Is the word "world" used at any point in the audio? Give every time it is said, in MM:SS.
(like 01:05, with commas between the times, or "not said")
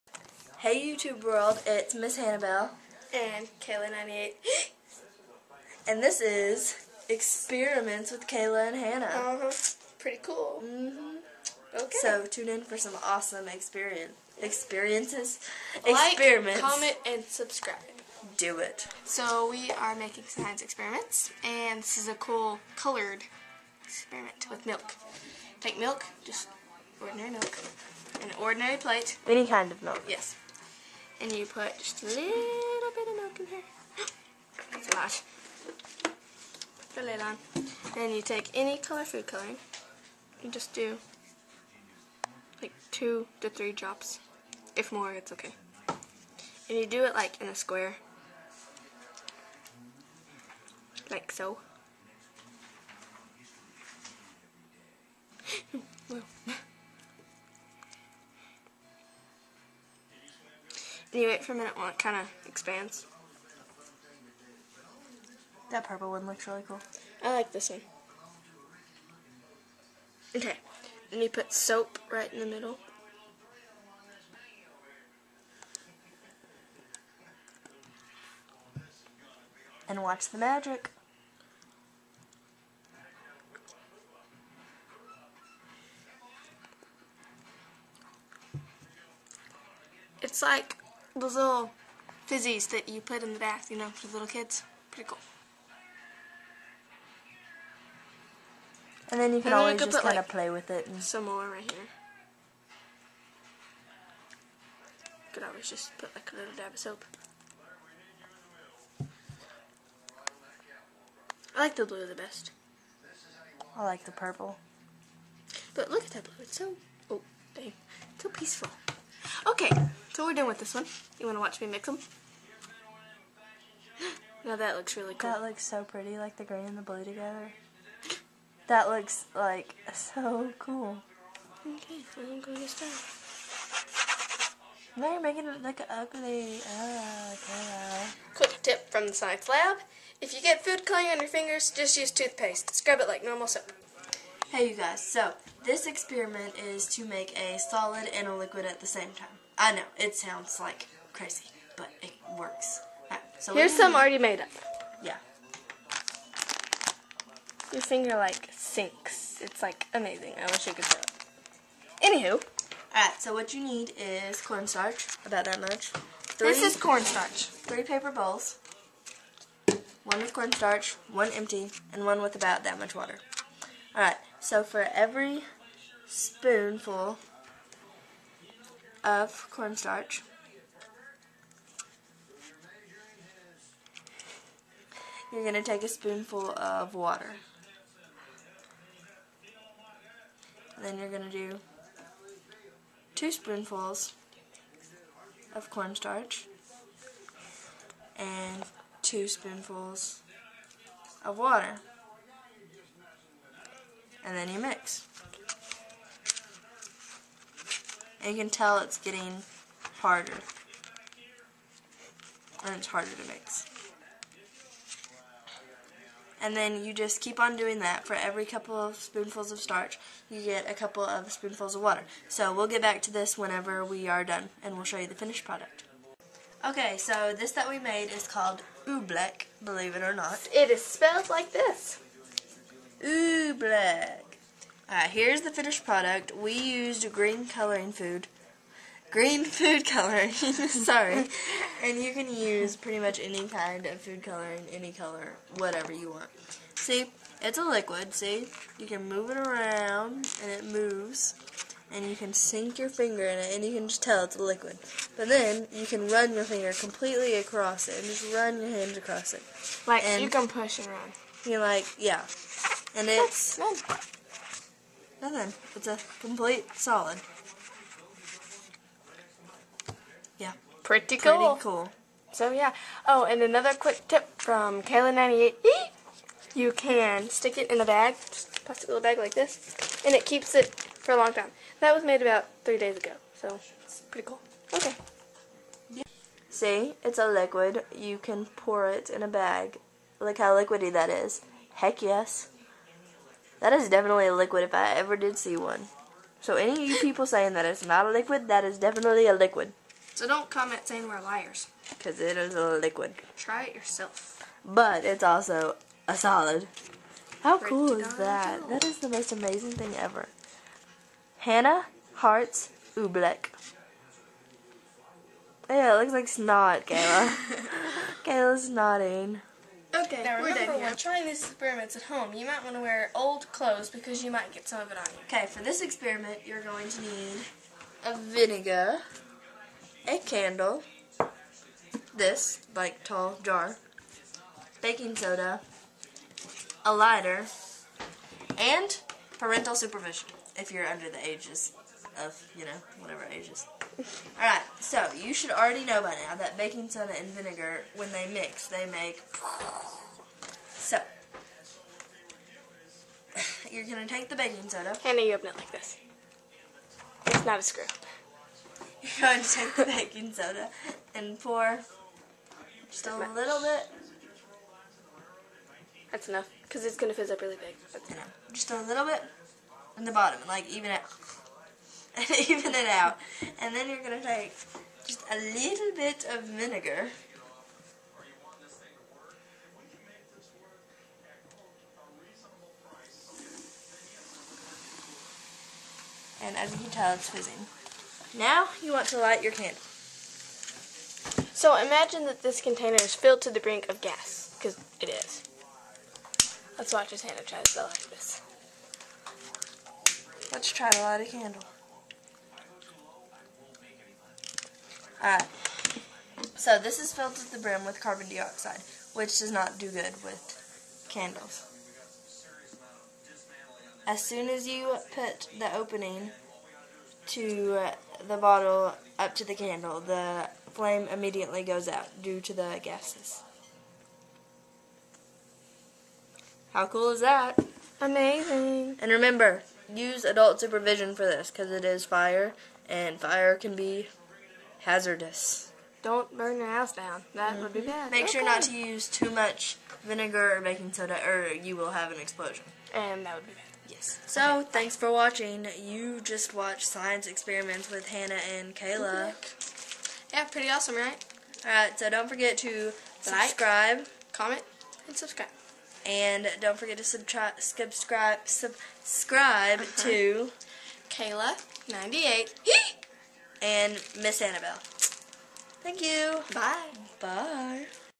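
00:01.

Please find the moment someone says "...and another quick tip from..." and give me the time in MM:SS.
04:33.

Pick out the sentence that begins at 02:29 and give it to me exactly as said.
I know, it sounds like crazy, but it works.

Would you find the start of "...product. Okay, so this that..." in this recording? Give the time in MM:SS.
03:45.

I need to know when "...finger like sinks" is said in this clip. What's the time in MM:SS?
02:37.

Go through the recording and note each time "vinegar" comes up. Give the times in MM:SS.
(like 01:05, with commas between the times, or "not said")
05:28, 05:47, 06:16, 07:20.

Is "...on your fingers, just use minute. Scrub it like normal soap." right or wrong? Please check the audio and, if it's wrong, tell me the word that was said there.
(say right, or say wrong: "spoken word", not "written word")
wrong: "toothpaste", not "minute".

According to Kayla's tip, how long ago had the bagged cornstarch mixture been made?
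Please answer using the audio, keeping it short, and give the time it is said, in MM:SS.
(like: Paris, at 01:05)
About 3 days, at 04:42.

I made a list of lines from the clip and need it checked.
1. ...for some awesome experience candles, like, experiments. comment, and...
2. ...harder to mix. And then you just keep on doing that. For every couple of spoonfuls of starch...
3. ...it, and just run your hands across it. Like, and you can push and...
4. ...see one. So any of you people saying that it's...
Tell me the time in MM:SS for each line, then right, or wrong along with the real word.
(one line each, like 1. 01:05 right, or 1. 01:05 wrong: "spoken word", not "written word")
1. 00:12 wrong: "experiences", not "candles"
2. 03:32 right
3. 04:17 right
4. 04:55 right.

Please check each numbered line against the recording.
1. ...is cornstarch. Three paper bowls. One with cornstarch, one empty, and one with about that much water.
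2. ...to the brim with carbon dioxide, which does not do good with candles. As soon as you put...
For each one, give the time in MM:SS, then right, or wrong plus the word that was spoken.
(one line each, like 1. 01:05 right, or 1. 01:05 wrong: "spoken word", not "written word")
1. 02:46 right
2. 06:47 right.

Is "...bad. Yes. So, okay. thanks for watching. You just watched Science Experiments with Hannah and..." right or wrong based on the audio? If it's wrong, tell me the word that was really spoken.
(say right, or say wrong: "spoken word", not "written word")
right.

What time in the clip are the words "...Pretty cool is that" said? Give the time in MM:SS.
05:07.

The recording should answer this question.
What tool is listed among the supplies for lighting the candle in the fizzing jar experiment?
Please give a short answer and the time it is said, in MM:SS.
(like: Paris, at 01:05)
A lighter, at 05:36.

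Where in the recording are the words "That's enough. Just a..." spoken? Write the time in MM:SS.
06:07.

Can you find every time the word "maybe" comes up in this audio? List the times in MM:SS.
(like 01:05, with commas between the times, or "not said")
not said.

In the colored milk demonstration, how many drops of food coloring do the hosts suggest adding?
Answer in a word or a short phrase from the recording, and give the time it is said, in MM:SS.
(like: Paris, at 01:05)
2 to 3, at 00:42.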